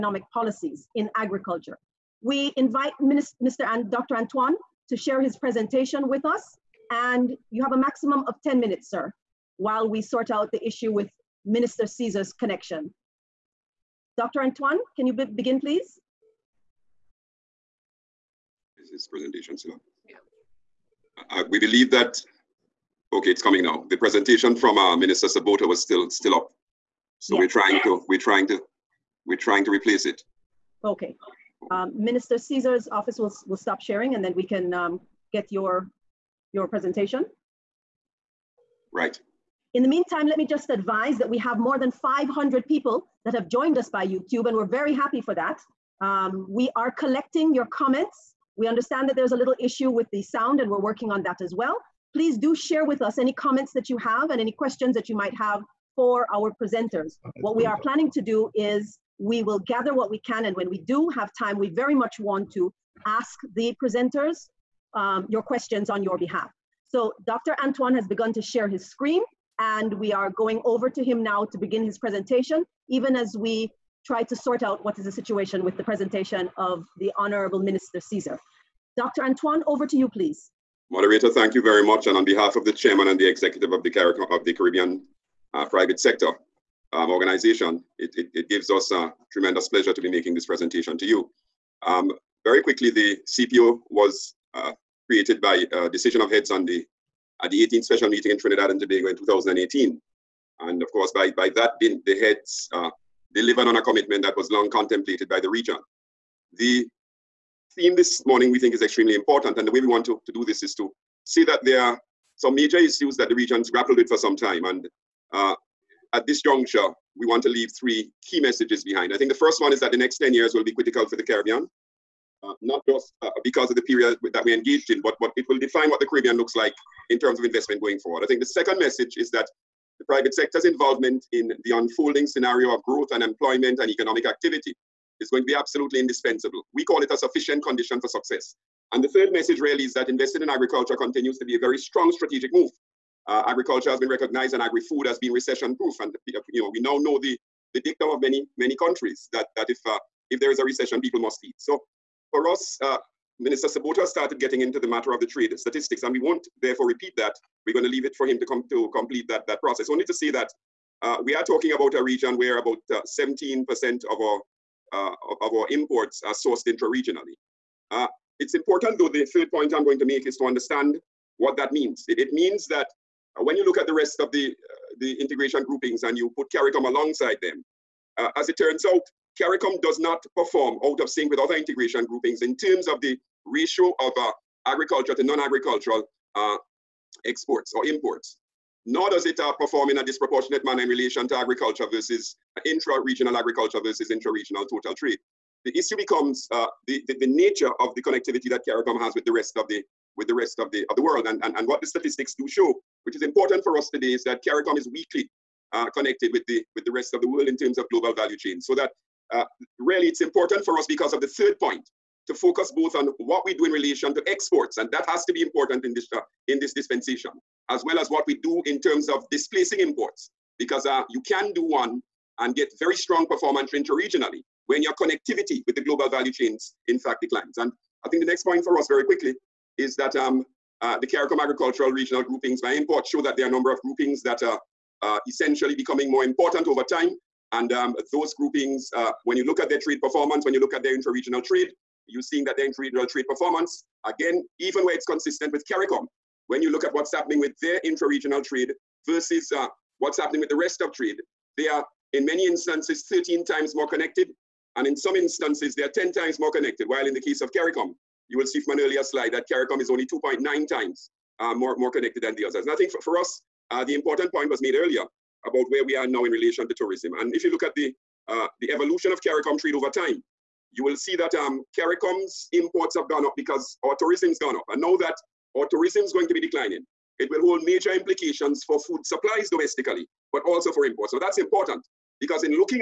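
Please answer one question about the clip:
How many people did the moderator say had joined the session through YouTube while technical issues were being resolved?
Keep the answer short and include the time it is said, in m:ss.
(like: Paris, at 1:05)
more than 500, at 0:41.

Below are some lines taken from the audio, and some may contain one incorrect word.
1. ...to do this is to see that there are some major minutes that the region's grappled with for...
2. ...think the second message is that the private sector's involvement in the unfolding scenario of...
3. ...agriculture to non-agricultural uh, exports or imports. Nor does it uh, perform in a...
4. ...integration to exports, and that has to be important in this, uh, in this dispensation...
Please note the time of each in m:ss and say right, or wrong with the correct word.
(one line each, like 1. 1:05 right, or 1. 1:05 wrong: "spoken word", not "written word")
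1. 1:50 wrong: "issues", not "minutes"
2. 2:08 right
3. 3:04 right
4. 3:33 wrong: "relation", not "integration".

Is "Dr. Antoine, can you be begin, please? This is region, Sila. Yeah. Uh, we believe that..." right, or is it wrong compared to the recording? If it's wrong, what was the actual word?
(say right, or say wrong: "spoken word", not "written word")
wrong: "presentation", not "region".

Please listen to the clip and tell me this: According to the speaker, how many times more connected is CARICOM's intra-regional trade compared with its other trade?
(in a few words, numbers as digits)
2.9 times.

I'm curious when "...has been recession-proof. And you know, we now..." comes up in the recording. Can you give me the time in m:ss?
2:25.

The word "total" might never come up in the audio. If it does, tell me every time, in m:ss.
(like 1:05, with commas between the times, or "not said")
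3:14.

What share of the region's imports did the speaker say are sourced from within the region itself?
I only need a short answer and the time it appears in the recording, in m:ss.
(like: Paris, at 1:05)
17%, at 2:42.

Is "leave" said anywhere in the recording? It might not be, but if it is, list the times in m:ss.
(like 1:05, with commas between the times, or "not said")
1:57, 2:37.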